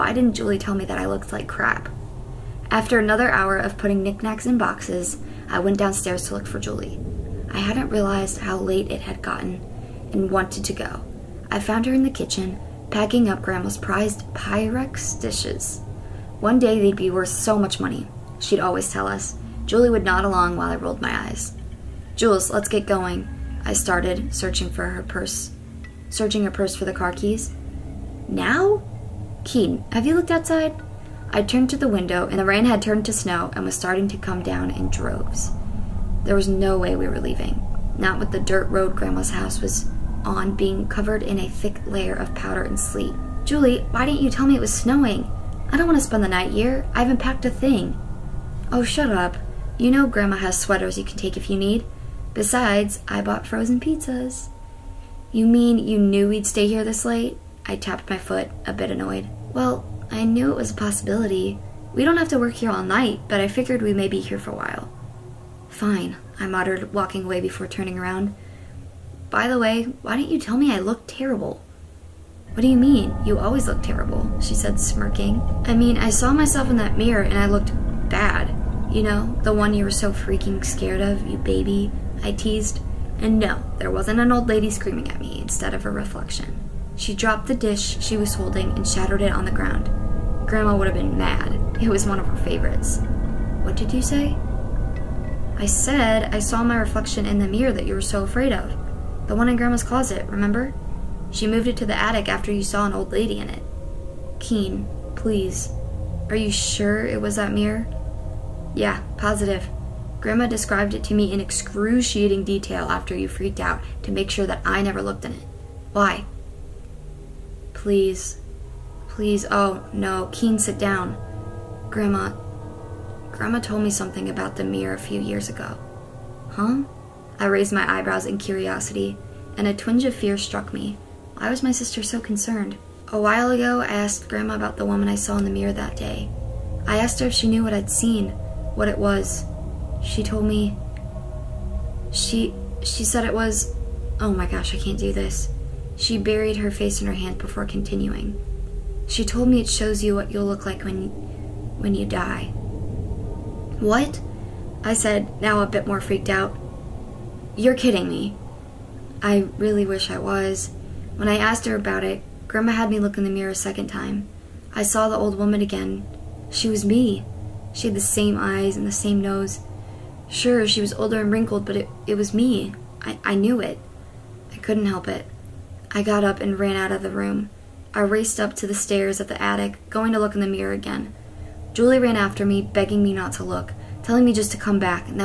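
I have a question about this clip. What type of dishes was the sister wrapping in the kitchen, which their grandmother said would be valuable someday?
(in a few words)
Pyrex.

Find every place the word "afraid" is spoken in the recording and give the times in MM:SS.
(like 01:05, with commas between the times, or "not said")
01:38.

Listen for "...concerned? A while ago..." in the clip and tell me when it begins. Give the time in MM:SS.
02:12.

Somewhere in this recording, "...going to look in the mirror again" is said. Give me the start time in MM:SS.
02:59.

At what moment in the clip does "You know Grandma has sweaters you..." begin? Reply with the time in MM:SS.
00:49.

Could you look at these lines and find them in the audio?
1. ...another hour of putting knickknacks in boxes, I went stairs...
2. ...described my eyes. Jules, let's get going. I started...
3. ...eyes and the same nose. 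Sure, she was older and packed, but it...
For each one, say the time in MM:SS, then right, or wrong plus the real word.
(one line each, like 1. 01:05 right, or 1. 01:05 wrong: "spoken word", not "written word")
1. 00:02 wrong: "downstairs", not "stairs"
2. 00:20 wrong: "rolled", not "described"
3. 02:48 wrong: "wrinkled", not "packed".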